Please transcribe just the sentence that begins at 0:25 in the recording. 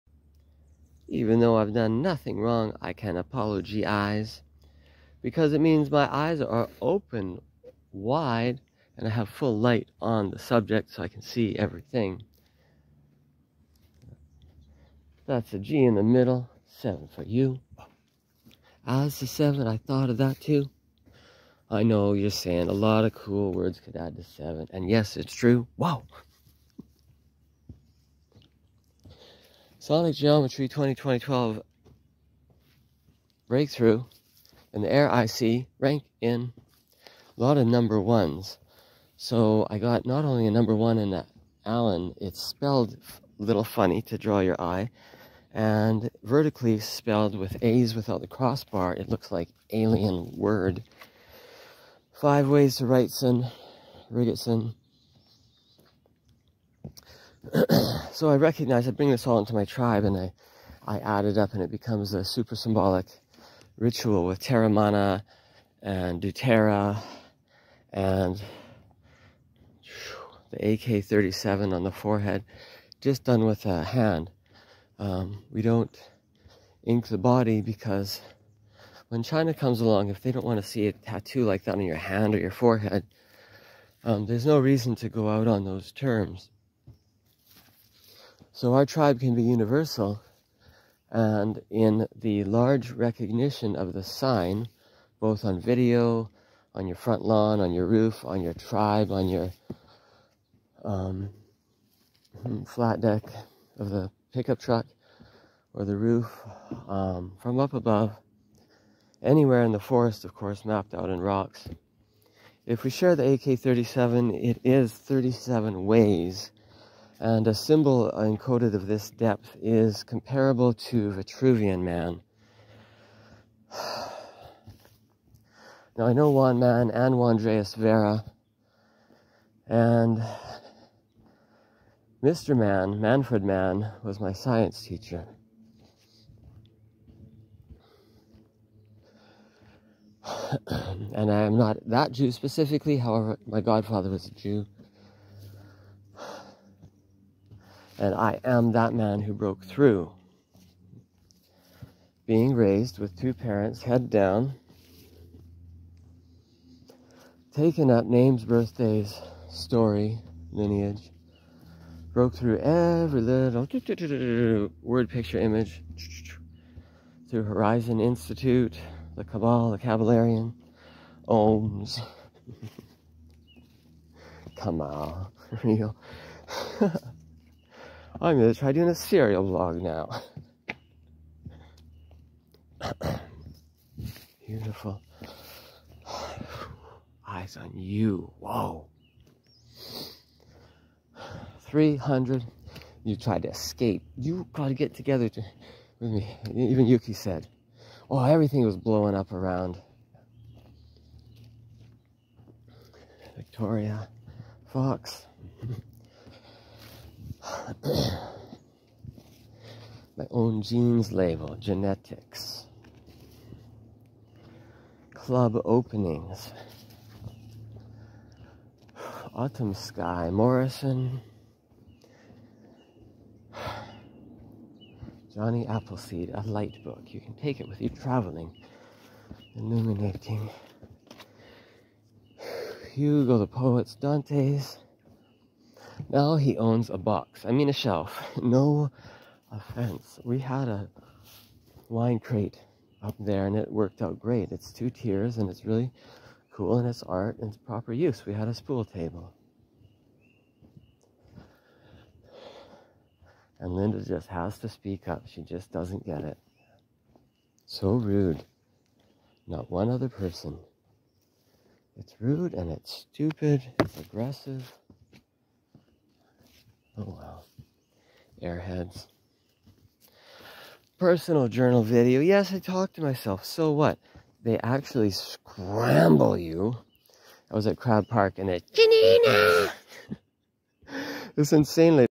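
Wow, Sonic Geometry 2020-12 breakthrough and the air IC rank in a lot of number ones.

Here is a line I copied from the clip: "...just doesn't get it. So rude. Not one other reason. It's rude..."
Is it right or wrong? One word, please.
wrong.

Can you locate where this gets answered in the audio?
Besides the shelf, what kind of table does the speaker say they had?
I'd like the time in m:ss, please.
4:08.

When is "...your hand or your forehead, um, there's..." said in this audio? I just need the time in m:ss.
1:21.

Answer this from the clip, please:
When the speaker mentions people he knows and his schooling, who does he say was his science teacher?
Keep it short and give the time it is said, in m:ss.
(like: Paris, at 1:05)
Manfred Man, at 2:13.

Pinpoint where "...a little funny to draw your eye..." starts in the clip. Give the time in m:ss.
0:43.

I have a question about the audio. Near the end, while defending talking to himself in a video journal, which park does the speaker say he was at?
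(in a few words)
Crab Park.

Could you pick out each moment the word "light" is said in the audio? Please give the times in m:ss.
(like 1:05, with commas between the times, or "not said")
0:09, 3:46.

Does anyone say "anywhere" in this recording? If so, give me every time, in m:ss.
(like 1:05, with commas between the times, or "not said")
1:49.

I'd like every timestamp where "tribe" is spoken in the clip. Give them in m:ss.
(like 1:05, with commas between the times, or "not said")
0:59, 1:28, 1:38.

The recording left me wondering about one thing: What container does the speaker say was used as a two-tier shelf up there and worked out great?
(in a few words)
Wine crate.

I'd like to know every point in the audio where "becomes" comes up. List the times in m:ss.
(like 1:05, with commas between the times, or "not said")
1:01.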